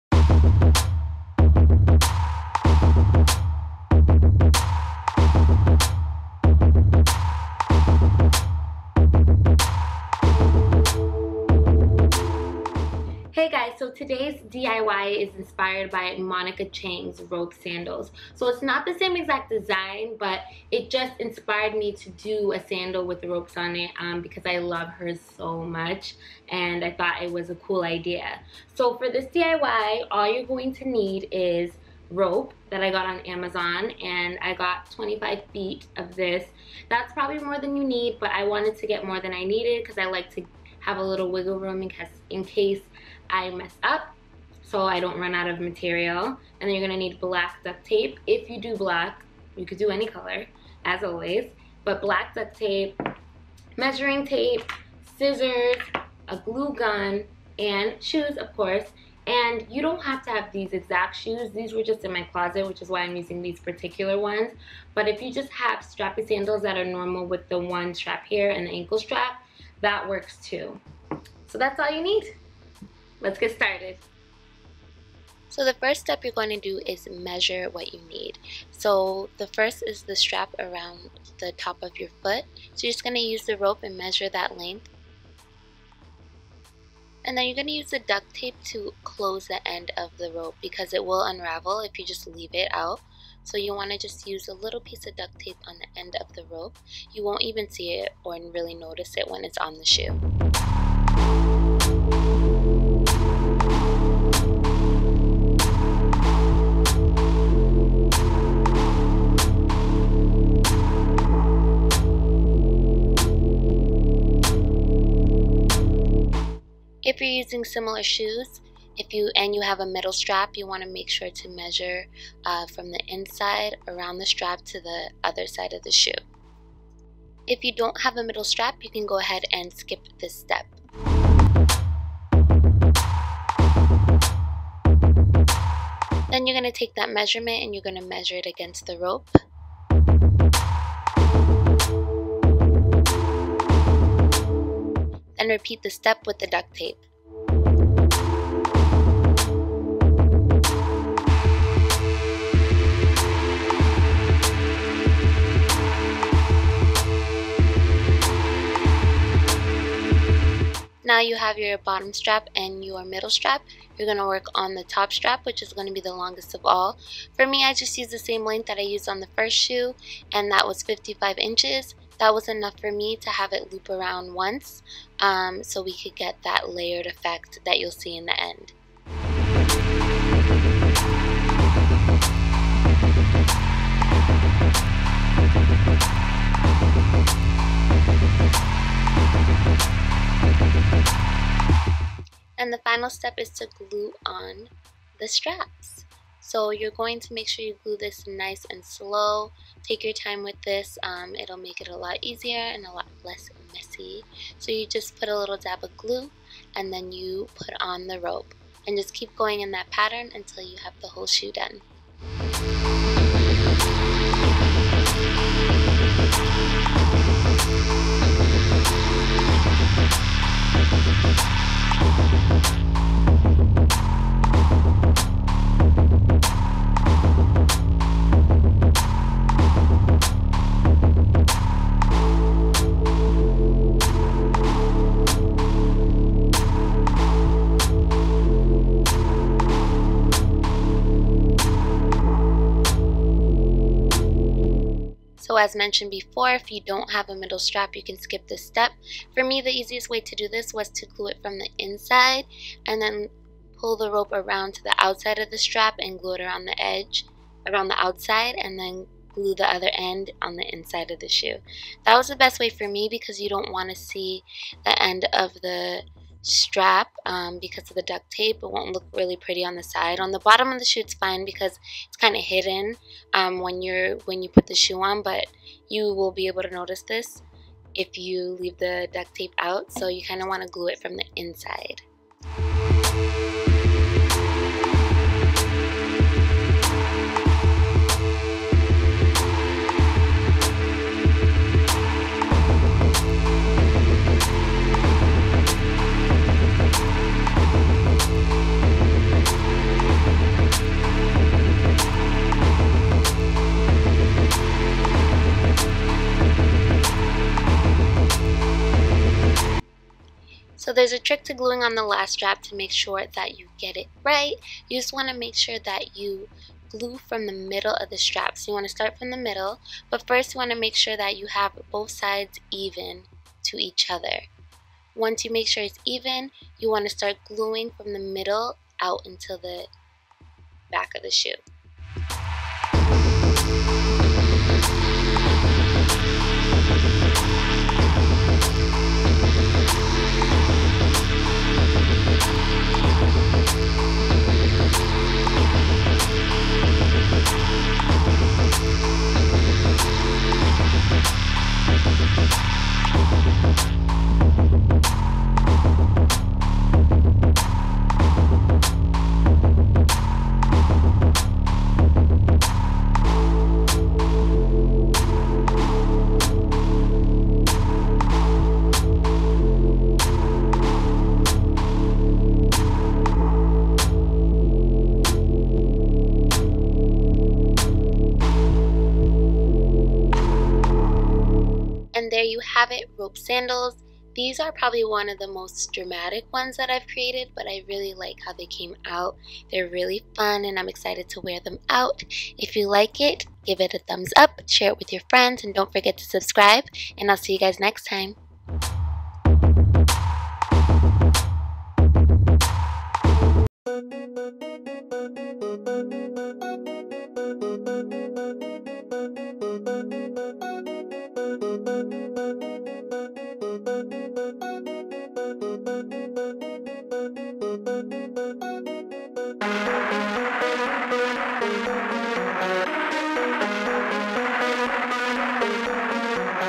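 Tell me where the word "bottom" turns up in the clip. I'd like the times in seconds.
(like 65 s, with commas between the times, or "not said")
161 s, 270 s.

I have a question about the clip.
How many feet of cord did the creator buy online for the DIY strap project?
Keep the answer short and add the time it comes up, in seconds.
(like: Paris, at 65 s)
25 feet, at 34 s.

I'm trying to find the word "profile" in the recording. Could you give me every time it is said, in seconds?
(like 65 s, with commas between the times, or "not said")
not said.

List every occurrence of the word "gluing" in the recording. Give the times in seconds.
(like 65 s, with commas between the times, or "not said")
311 s, 327 s.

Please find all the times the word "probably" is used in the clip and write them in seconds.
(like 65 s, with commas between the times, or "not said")
37 s, 384 s.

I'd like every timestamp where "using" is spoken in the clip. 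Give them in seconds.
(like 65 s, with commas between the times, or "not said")
63 s, 117 s.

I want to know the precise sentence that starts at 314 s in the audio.
You just want to make sure that you glue from the middle of the strap.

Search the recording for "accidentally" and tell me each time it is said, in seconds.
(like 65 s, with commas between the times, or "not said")
not said.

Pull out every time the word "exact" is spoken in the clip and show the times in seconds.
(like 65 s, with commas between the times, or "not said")
19 s, 60 s.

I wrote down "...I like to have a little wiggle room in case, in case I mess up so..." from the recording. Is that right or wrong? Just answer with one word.
right.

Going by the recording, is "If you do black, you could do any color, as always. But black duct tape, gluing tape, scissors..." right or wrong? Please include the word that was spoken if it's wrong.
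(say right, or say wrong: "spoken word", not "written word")
wrong: "measuring", not "gluing".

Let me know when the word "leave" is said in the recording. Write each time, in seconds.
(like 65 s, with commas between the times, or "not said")
92 s, 278 s.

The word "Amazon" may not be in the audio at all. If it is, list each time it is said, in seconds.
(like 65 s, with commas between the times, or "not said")
33 s.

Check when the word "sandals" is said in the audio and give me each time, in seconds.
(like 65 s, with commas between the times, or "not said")
17 s, 22 s, 66 s, 383 s.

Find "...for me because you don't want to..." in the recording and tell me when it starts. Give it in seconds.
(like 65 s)
262 s.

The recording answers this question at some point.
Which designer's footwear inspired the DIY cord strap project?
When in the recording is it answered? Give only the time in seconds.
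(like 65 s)
16 s.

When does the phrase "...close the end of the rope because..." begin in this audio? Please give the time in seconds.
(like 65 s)
89 s.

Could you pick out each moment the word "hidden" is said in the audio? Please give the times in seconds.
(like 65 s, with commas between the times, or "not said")
272 s.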